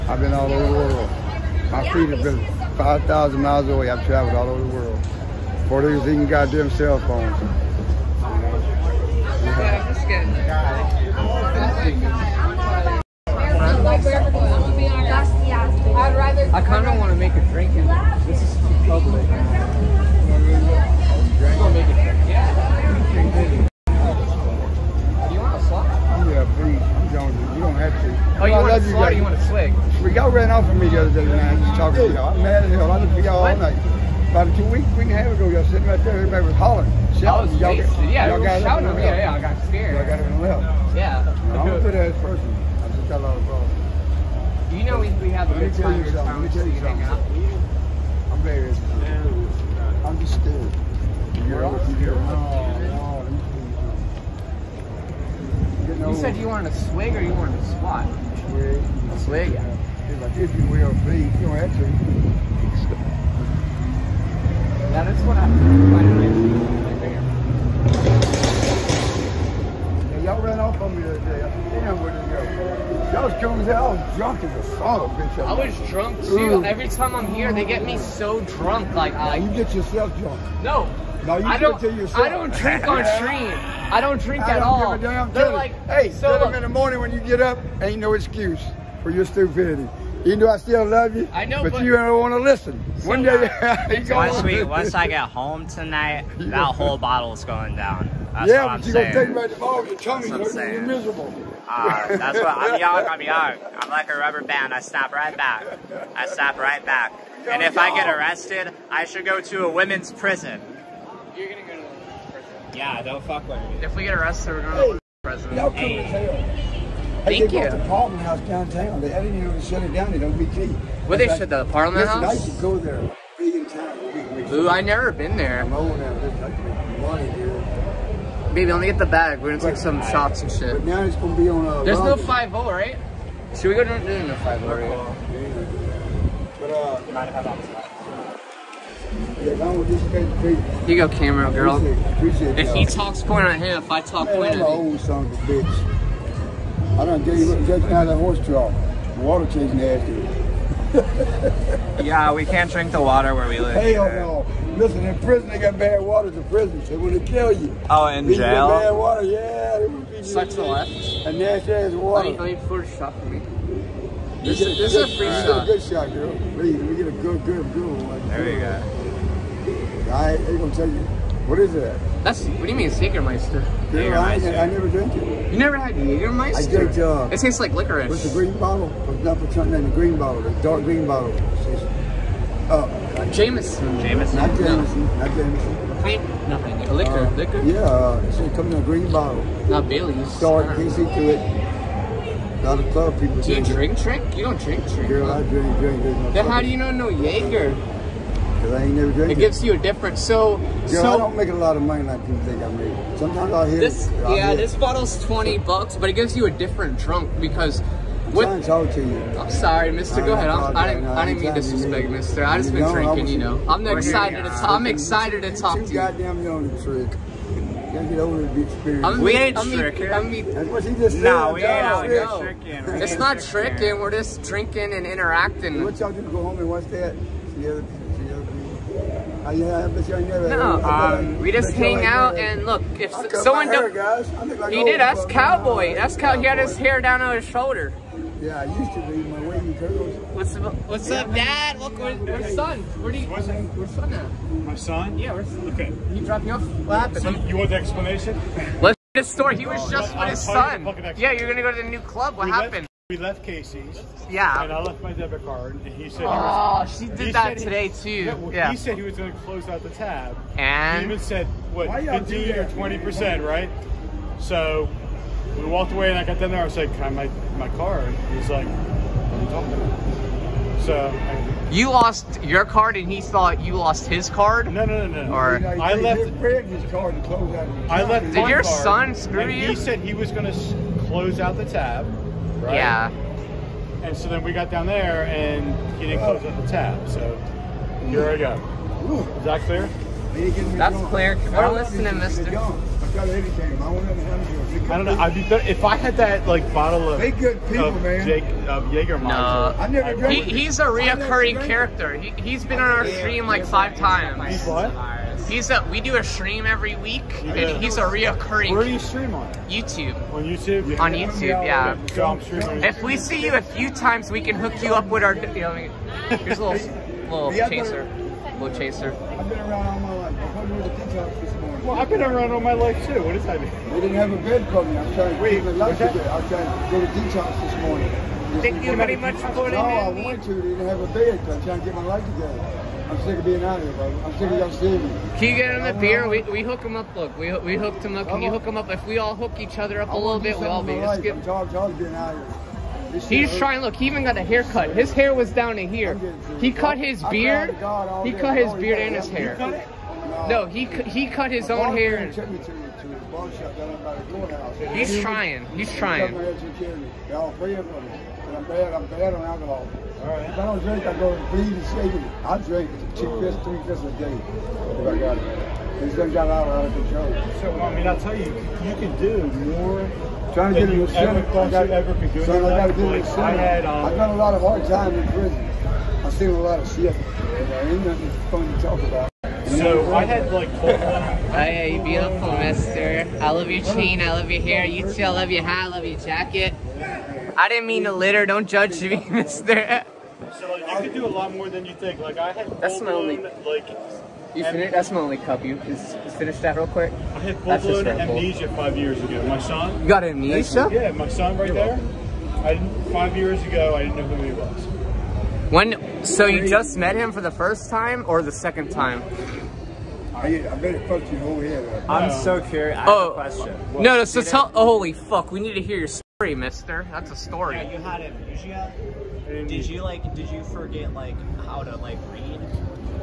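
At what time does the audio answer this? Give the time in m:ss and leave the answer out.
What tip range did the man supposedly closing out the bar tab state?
4:22.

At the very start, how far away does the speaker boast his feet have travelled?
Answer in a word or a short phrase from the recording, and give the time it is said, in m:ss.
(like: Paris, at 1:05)
5,000 miles, at 0:02.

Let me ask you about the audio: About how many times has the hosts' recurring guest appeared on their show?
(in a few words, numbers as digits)
5 times.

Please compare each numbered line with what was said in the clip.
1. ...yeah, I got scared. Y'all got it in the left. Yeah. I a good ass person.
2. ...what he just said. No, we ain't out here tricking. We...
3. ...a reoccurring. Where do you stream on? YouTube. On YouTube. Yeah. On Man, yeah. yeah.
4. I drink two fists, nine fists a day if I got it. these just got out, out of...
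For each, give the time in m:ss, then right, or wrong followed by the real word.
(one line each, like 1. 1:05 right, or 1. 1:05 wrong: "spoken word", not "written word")
1. 0:39 right
2. 3:40 right
3. 5:07 wrong: "YouTube", not "Man"
4. 6:02 wrong: "three", not "nine".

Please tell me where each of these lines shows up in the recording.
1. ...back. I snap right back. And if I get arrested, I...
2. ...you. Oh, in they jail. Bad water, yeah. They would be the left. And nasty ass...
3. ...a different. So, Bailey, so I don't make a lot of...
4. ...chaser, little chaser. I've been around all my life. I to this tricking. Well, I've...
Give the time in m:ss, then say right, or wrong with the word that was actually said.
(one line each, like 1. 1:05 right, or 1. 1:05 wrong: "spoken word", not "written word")
1. 1:45 right
2. 2:37 right
3. 3:19 wrong: "Girl", not "Bailey"
4. 5:17 wrong: "morning", not "tricking".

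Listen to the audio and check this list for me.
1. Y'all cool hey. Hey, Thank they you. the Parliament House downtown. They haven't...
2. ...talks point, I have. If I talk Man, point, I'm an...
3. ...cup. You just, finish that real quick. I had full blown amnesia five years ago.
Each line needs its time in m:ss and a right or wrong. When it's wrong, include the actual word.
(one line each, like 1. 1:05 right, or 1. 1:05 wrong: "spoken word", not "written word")
1. 1:55 right
2. 2:22 right
3. 6:35 right.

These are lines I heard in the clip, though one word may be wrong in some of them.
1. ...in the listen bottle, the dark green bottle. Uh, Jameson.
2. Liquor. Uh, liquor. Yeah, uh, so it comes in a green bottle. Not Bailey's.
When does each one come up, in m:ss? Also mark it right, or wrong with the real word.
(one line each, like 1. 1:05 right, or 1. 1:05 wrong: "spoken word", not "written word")
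1. 2:59 wrong: "green", not "listen"
2. 3:06 right.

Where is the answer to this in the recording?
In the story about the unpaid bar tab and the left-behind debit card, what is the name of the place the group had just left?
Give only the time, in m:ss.
4:13.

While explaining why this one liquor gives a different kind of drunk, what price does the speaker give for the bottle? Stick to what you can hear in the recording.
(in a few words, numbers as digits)
$20.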